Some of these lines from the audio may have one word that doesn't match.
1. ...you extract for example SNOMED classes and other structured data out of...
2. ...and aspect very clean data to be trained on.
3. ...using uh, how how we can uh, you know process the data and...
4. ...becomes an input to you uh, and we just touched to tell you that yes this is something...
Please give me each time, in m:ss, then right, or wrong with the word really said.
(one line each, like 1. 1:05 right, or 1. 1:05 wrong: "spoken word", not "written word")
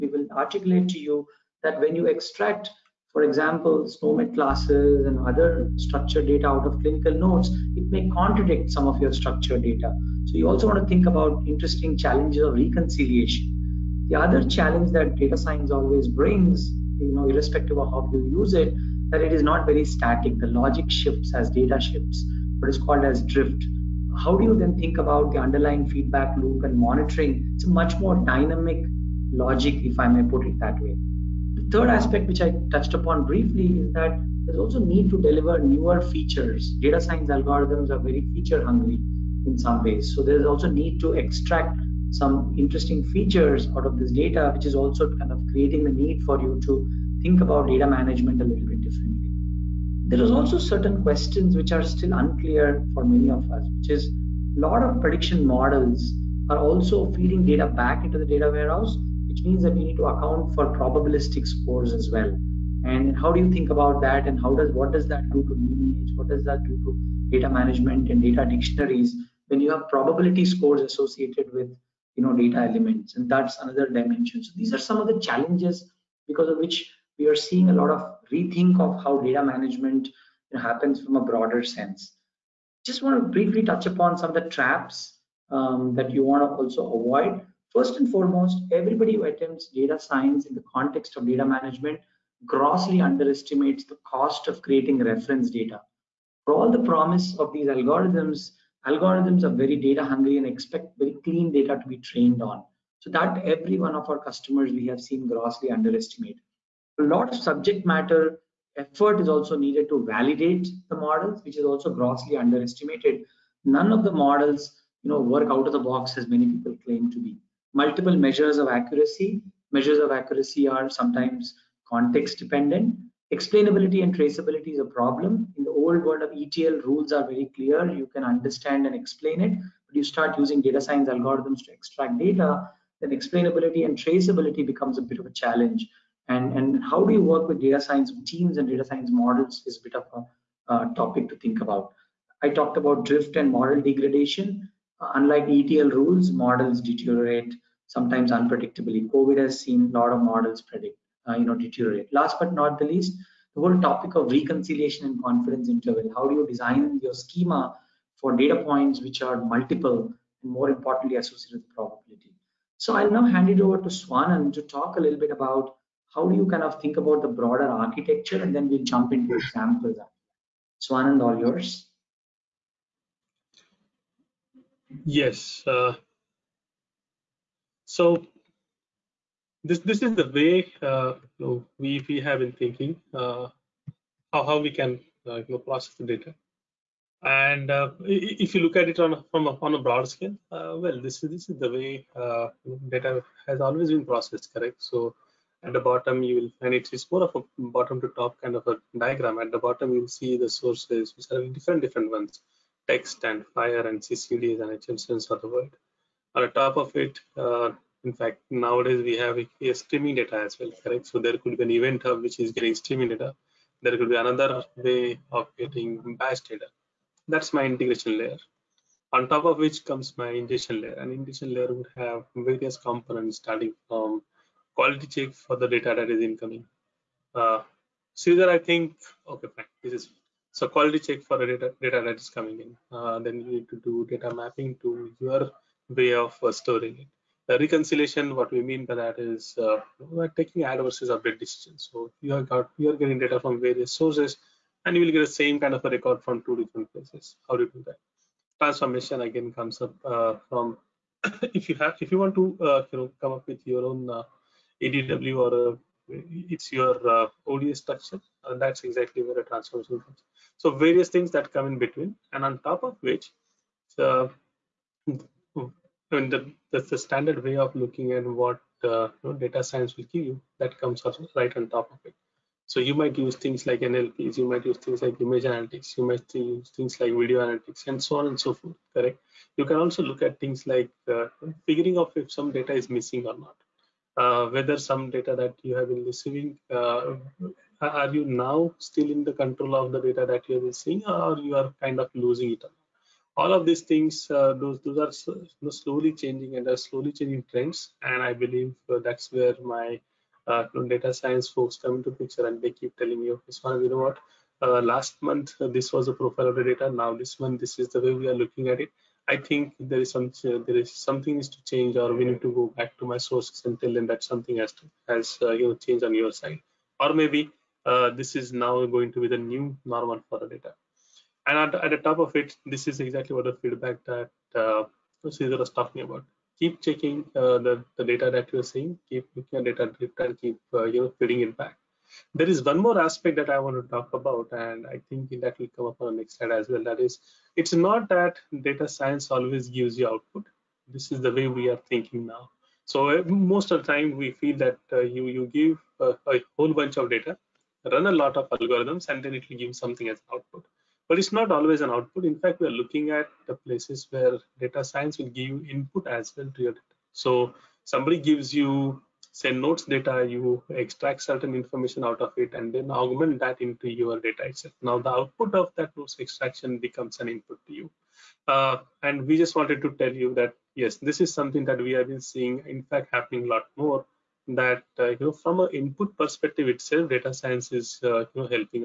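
1. 0:01 right
2. 1:40 wrong: "expect", not "aspect"
3. 3:02 wrong: "thinking", not "using"
4. 6:06 wrong: "wanted", not "touched".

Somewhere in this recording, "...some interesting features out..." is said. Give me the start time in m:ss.
0:42.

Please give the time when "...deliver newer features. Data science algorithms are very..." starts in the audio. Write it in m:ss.
0:35.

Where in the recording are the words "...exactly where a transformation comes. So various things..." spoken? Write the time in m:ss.
4:18.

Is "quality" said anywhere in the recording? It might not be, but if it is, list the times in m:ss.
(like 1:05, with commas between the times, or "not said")
3:44, 3:50.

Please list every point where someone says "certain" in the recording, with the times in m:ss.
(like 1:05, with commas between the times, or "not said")
0:50, 6:01.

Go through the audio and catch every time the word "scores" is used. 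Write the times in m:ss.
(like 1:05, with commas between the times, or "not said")
1:01, 1:10.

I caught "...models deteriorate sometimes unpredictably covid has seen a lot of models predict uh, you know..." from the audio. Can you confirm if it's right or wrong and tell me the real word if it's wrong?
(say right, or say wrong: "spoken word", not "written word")
right.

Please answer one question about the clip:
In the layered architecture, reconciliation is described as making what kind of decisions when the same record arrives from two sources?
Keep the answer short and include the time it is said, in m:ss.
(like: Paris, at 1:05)
add versus update, at 4:00.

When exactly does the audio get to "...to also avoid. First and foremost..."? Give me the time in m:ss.
1:26.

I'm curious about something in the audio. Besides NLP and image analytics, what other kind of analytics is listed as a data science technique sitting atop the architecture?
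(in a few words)
video analytics.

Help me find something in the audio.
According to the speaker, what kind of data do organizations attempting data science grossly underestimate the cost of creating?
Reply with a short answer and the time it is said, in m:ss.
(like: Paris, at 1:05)
reference data, at 1:34.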